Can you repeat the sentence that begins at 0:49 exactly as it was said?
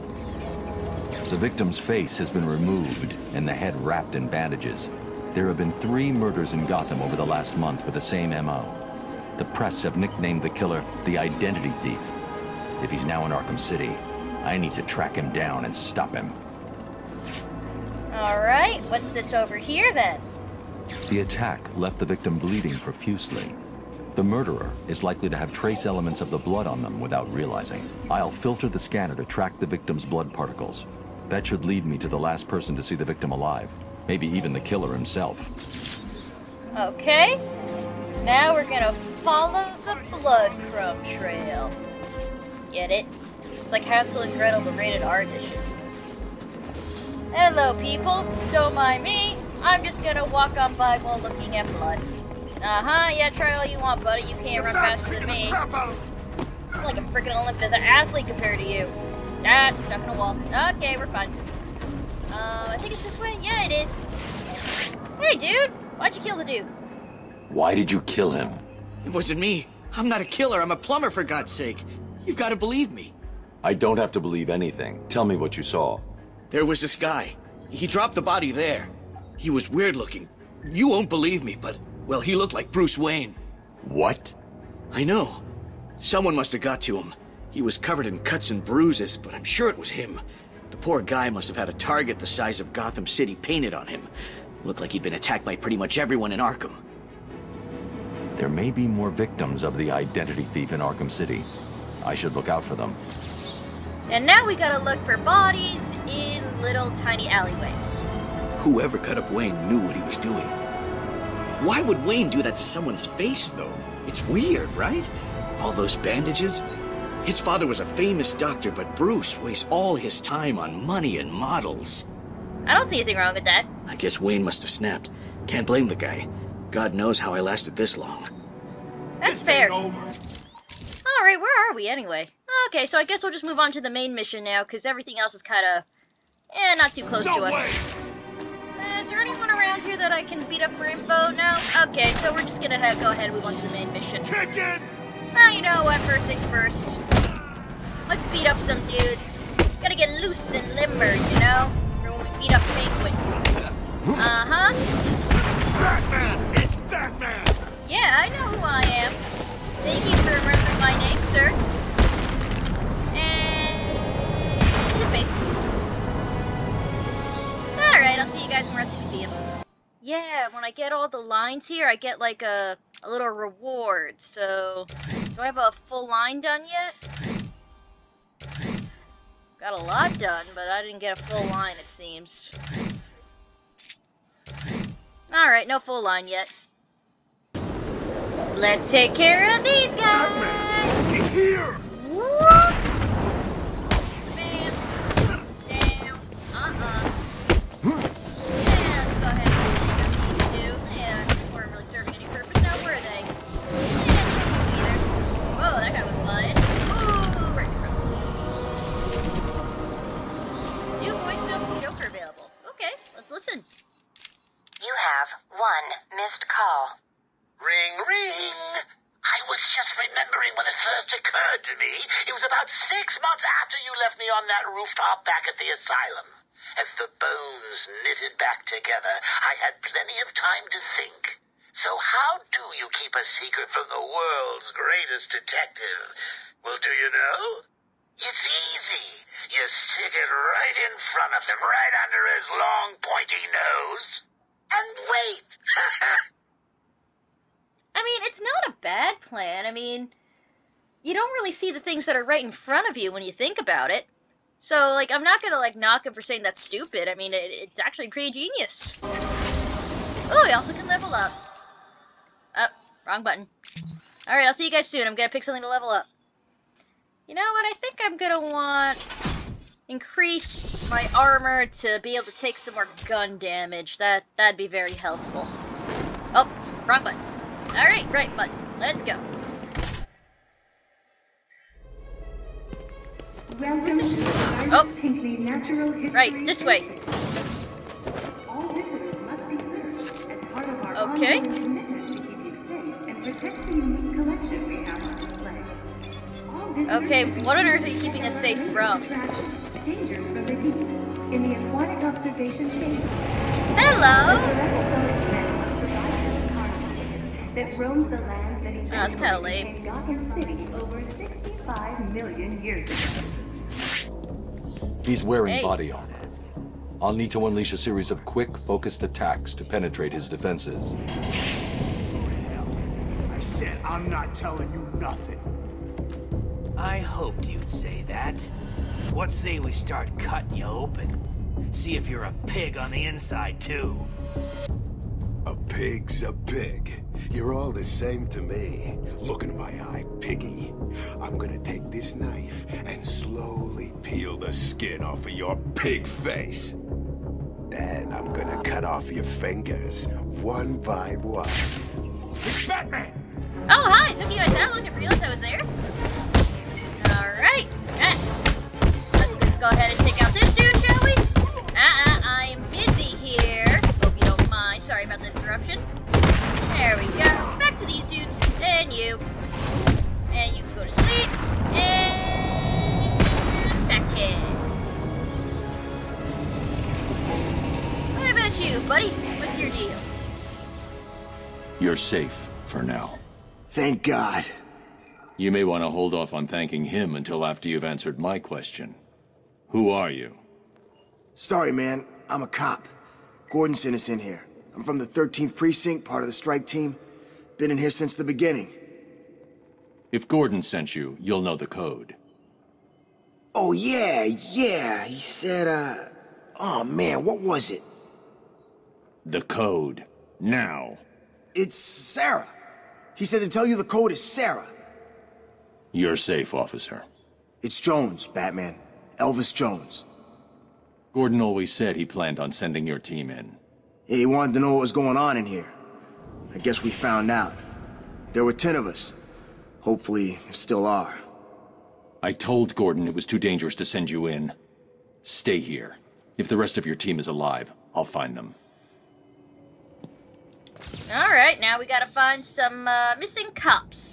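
I'm just gonna walk on by while looking at blood.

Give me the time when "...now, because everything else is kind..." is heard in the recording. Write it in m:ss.
2:14.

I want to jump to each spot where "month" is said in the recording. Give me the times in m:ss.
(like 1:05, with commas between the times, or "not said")
0:07, 3:43.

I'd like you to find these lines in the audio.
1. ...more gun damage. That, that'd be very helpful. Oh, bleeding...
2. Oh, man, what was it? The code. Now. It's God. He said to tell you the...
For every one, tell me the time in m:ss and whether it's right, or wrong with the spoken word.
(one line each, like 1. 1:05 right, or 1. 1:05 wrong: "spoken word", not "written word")
1. 4:32 wrong: "wrong", not "bleeding"
2. 6:46 wrong: "Sarah", not "God".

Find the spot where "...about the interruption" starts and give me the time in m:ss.
6:05.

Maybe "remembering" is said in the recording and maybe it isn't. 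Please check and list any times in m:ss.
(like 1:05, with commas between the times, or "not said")
2:40, 3:39.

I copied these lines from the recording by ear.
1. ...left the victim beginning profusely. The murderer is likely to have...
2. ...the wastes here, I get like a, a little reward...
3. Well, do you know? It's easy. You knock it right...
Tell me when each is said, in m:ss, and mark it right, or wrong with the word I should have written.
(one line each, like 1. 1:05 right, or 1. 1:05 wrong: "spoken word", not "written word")
1. 0:21 wrong: "bleeding", not "beginning"
2. 2:51 wrong: "lines", not "wastes"
3. 3:56 wrong: "stick", not "knock".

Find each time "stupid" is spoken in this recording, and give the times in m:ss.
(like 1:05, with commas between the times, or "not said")
4:16.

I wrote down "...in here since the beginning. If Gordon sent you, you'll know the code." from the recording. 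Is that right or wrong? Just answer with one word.
right.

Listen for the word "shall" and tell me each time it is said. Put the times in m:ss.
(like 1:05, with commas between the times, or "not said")
6:00.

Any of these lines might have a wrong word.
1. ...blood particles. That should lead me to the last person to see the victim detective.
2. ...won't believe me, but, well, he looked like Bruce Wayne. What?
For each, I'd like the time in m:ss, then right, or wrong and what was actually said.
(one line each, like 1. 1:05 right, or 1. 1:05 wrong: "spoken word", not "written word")
1. 0:30 wrong: "alive", not "detective"
2. 1:20 right.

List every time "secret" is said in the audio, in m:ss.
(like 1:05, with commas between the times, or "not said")
3:53.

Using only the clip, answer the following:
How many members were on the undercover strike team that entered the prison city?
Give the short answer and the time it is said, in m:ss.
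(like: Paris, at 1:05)
10, at 7:08.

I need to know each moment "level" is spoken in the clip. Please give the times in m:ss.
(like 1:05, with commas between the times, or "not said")
4:20, 4:25.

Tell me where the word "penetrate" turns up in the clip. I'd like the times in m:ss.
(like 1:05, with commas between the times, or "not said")
5:19.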